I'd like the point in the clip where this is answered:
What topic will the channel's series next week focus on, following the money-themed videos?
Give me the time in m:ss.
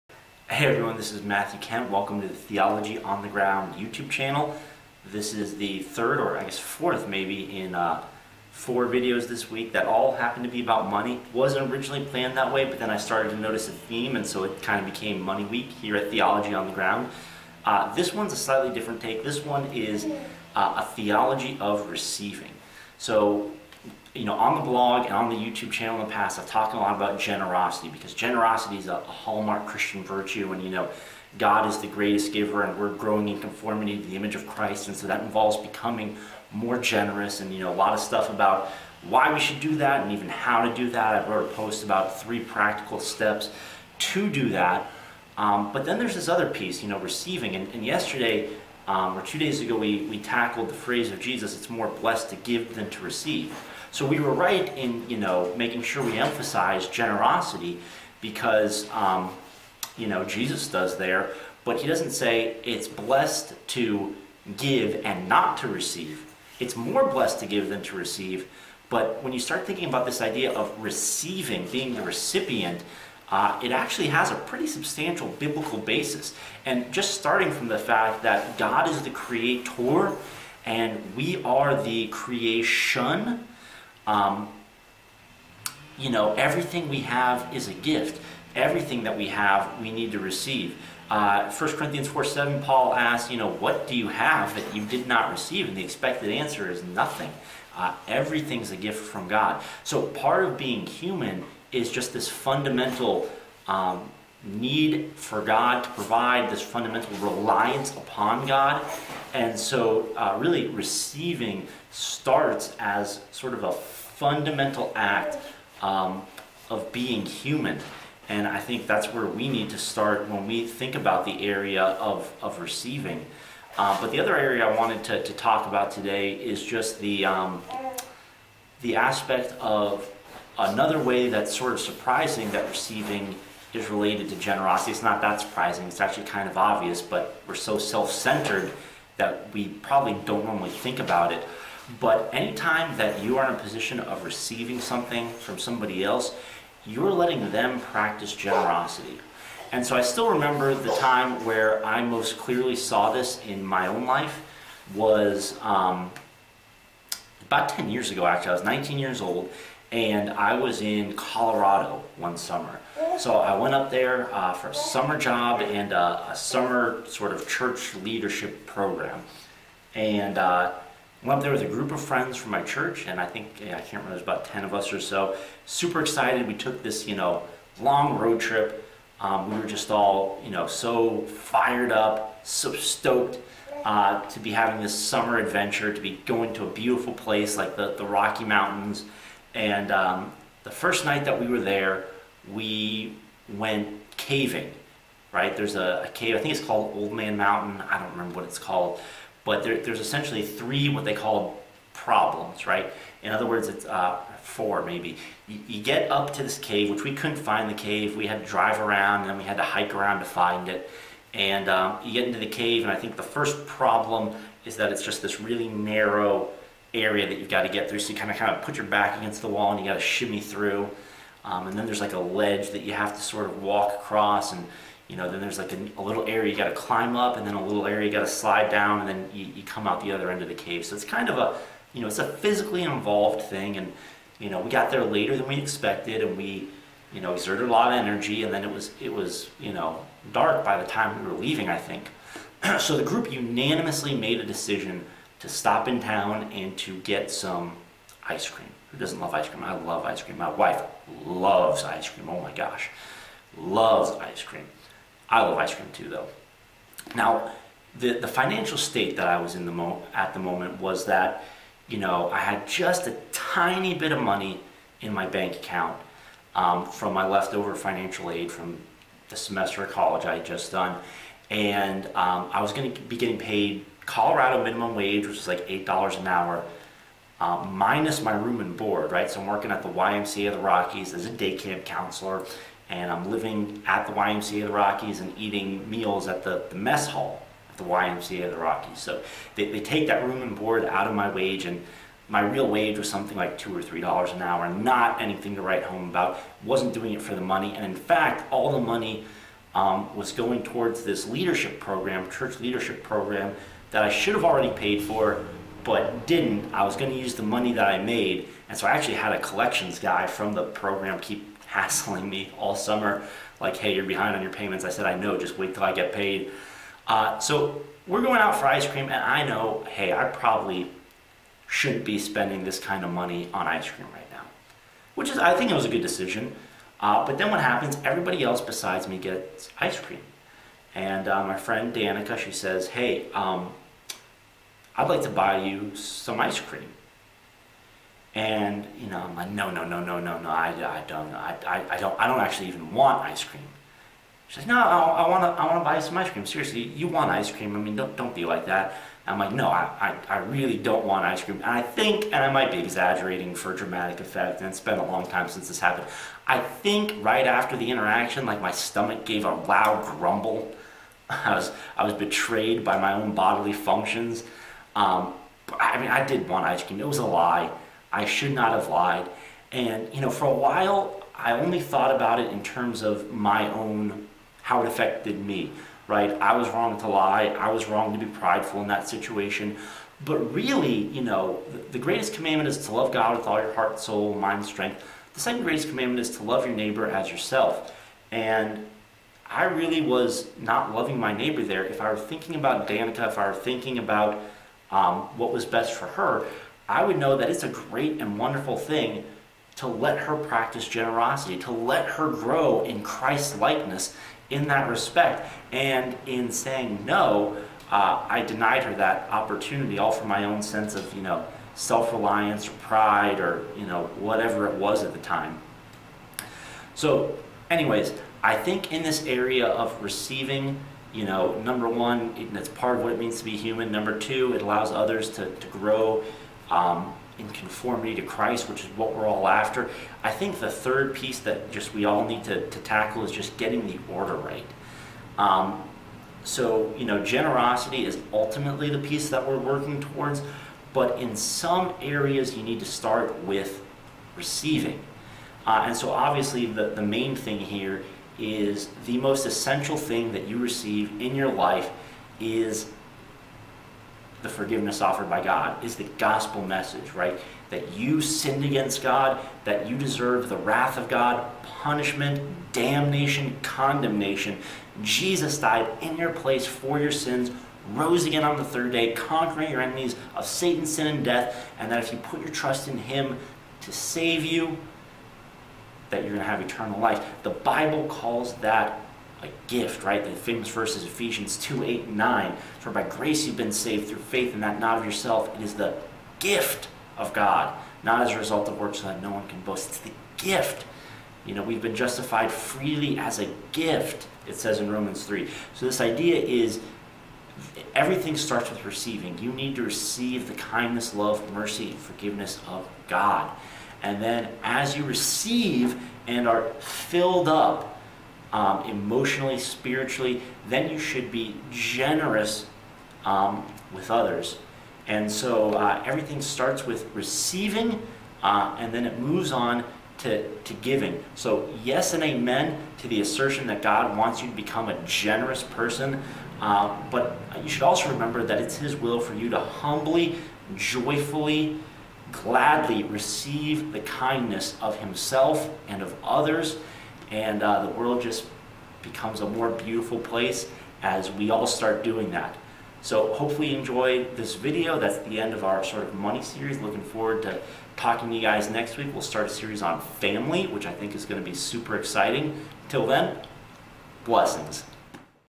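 9:10.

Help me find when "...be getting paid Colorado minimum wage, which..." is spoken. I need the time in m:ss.
4:33.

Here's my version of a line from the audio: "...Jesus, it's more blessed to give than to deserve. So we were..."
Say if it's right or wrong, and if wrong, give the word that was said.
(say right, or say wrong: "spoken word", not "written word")
wrong: "receive", not "deserve".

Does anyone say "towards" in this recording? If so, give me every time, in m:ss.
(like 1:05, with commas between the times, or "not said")
5:00, 7:20.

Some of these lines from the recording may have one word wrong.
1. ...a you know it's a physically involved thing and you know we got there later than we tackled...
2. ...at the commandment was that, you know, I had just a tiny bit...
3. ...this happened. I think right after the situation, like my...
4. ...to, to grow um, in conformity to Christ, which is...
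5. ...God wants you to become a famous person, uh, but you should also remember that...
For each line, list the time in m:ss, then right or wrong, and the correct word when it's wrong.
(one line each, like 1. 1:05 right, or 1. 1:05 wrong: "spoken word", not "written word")
1. 3:51 wrong: "expected", not "tackled"
2. 4:20 wrong: "moment", not "commandment"
3. 5:55 wrong: "interaction", not "situation"
4. 7:05 right
5. 8:43 wrong: "generous", not "famous".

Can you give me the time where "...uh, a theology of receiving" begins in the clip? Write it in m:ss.
0:20.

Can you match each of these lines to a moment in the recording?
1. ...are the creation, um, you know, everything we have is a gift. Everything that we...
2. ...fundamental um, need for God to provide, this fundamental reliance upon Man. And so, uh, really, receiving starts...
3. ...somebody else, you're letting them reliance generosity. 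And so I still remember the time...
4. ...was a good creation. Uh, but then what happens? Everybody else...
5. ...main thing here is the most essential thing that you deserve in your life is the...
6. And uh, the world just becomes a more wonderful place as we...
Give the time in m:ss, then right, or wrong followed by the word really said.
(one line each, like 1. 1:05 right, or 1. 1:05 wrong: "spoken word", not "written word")
1. 1:21 right
2. 1:42 wrong: "God", not "Man"
3. 2:25 wrong: "practice", not "reliance"
4. 5:25 wrong: "decision", not "creation"
5. 7:27 wrong: "receive", not "deserve"
6. 8:57 wrong: "beautiful", not "wonderful".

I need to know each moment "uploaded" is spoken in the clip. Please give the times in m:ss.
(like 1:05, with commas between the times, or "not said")
not said.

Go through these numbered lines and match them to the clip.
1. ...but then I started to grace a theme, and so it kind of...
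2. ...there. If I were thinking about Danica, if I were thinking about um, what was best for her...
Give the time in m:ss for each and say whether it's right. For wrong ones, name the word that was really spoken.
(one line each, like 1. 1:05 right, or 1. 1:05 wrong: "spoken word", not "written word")
1. 0:12 wrong: "notice", not "grace"
2. 6:31 right.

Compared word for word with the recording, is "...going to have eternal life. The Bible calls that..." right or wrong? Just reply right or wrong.
right.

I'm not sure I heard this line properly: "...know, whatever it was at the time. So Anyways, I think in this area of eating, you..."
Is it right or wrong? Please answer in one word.
wrong.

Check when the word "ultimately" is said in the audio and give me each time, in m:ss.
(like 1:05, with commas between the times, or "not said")
7:18.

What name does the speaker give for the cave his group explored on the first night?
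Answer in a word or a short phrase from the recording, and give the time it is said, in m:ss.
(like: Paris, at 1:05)
Old Man Mountain, at 3:16.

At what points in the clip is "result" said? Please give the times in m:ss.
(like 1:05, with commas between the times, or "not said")
8:08.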